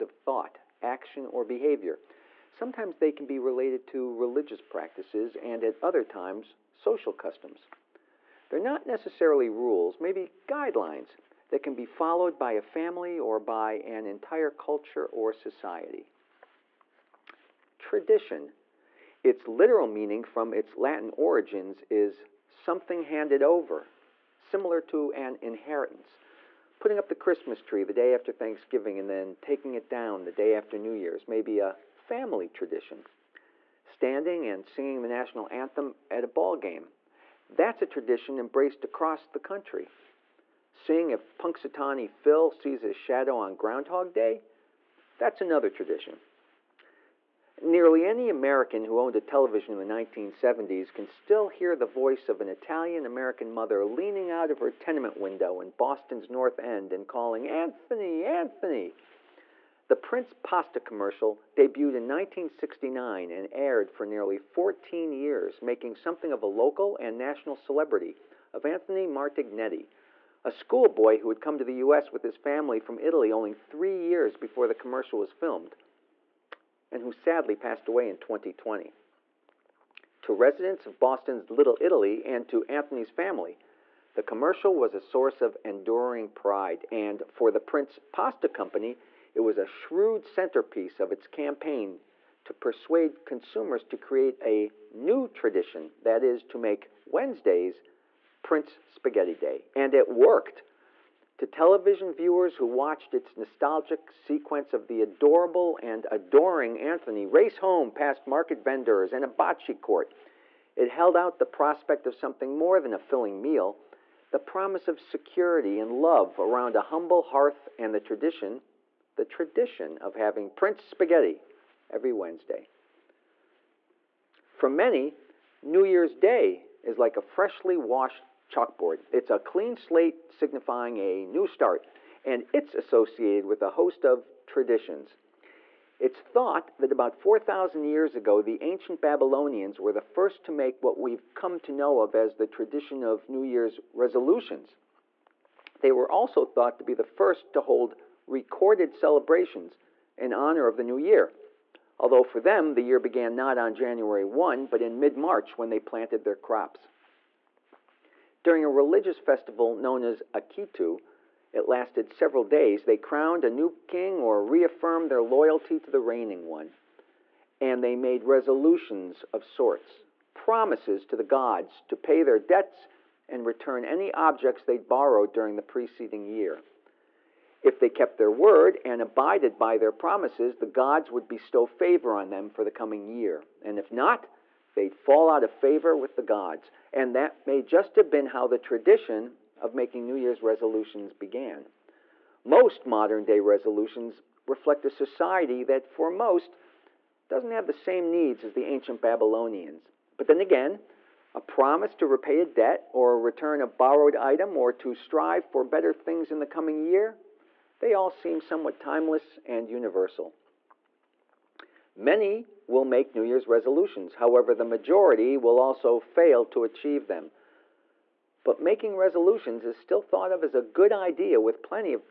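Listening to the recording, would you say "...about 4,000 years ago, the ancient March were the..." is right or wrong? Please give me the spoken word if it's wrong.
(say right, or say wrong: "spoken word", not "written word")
wrong: "Babylonians", not "March".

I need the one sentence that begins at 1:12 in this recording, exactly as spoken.
with his family from Italy only three years before the commercial was filmed, and who sadly passed away in 2020.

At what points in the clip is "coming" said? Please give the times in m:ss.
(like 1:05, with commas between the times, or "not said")
3:02, 3:26.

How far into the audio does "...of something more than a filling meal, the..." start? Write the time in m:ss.
1:52.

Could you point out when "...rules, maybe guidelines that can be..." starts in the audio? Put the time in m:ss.
0:09.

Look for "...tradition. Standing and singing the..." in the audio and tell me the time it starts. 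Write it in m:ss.
0:32.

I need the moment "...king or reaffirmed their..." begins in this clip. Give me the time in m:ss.
2:43.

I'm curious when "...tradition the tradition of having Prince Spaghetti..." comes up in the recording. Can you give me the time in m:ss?
1:57.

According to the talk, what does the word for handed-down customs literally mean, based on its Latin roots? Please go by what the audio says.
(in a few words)
something handed over.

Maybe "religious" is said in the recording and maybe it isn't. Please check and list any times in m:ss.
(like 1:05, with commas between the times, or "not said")
0:04, 2:38.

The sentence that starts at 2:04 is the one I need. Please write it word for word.
For many, New Year's Day is like a freshly washed chalkboard.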